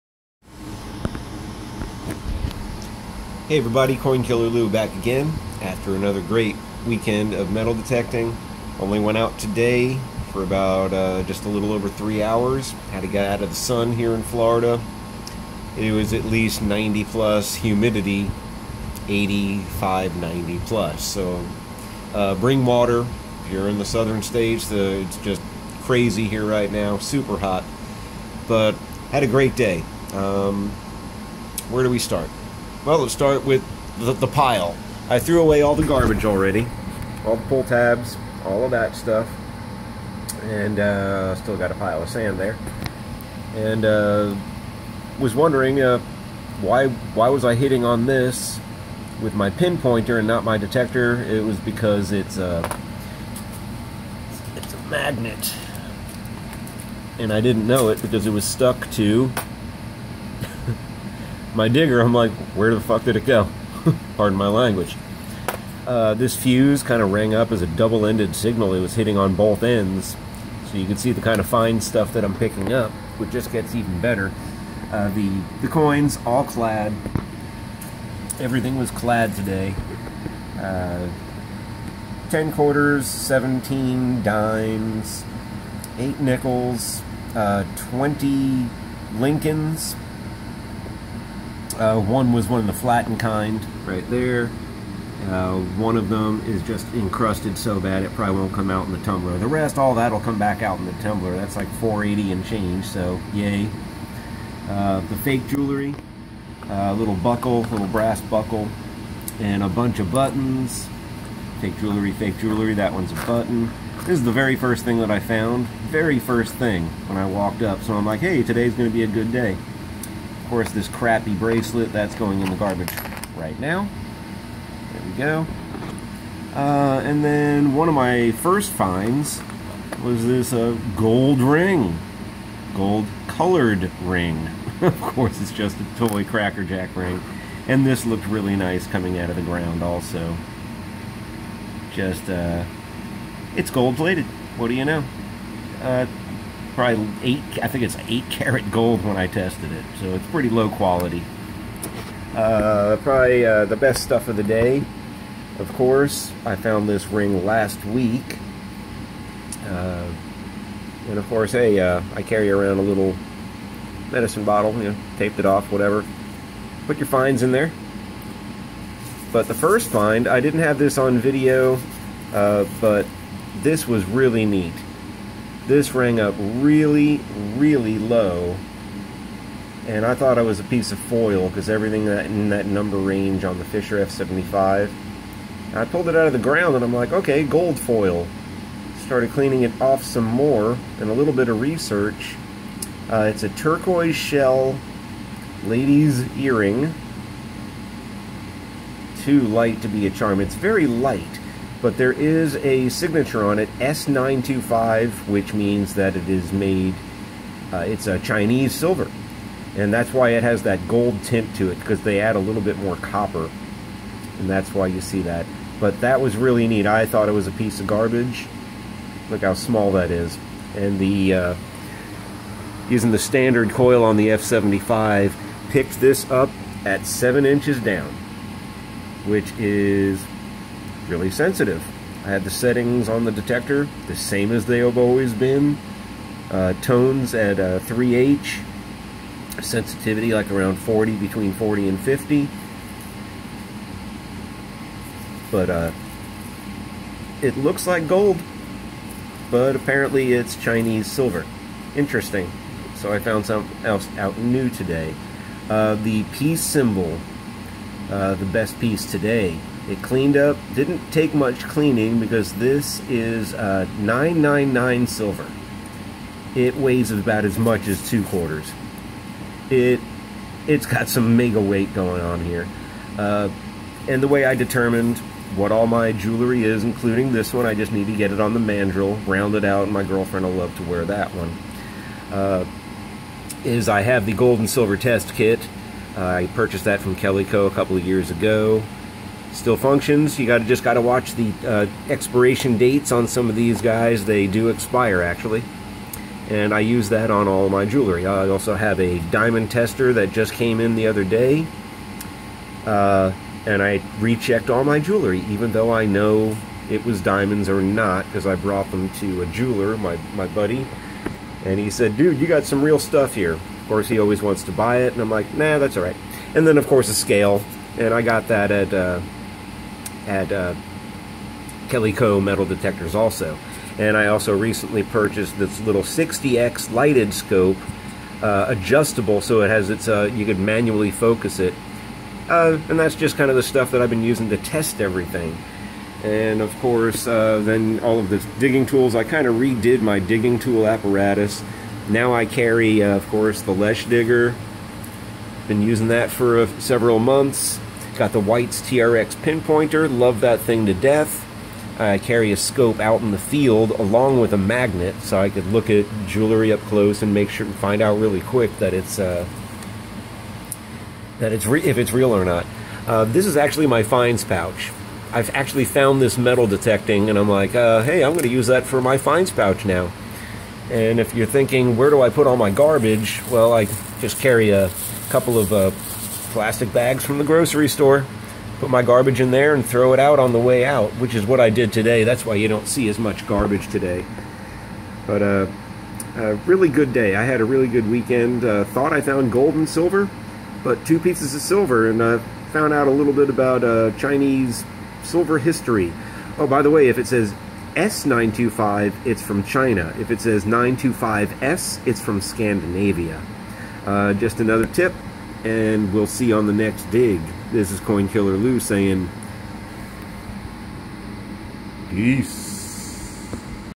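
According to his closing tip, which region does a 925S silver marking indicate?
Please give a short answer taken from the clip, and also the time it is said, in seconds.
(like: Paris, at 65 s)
Scandinavia, at 402 s.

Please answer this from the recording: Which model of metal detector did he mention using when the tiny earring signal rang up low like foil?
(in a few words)
Fisher F75.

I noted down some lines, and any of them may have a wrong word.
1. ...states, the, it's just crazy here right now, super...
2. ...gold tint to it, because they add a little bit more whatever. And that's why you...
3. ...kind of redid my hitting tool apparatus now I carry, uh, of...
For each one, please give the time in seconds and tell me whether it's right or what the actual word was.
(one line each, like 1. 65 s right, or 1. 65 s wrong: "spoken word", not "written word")
1. 24 s right
2. 210 s wrong: "copper", not "whatever"
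3. 339 s wrong: "digging", not "hitting".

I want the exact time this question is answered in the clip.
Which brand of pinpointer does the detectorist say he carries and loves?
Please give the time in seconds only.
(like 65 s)
348 s.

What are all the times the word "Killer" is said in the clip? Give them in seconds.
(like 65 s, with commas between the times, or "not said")
4 s, 408 s.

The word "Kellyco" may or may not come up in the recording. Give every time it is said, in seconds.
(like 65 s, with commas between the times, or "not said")
287 s, 321 s.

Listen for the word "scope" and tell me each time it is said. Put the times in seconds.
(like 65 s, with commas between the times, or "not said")
327 s, 352 s.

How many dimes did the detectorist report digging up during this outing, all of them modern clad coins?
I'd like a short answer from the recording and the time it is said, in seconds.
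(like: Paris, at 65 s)
17, at 83 s.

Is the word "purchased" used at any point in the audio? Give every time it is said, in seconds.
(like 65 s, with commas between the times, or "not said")
286 s, 325 s.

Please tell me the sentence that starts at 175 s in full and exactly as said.
This rang up really, really low.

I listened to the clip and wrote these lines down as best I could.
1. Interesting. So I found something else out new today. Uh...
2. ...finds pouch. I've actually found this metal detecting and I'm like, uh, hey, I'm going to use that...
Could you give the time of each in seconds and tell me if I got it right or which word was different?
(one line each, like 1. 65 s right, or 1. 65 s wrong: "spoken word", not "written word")
1. 251 s right
2. 364 s right.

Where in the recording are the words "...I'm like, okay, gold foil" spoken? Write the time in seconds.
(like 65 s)
186 s.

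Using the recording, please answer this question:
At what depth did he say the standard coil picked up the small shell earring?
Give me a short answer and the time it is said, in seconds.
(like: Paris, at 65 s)
7 inches, at 227 s.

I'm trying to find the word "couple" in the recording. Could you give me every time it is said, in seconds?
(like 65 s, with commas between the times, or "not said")
287 s, 375 s.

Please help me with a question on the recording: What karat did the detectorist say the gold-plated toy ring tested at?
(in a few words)
8 karat.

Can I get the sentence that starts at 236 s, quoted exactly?
Uh, tones at uh, 3H, sensitivity like around 40, between 40 and 50.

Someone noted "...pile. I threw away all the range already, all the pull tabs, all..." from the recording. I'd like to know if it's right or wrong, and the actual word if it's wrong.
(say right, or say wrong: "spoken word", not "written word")
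wrong: "garbage", not "range".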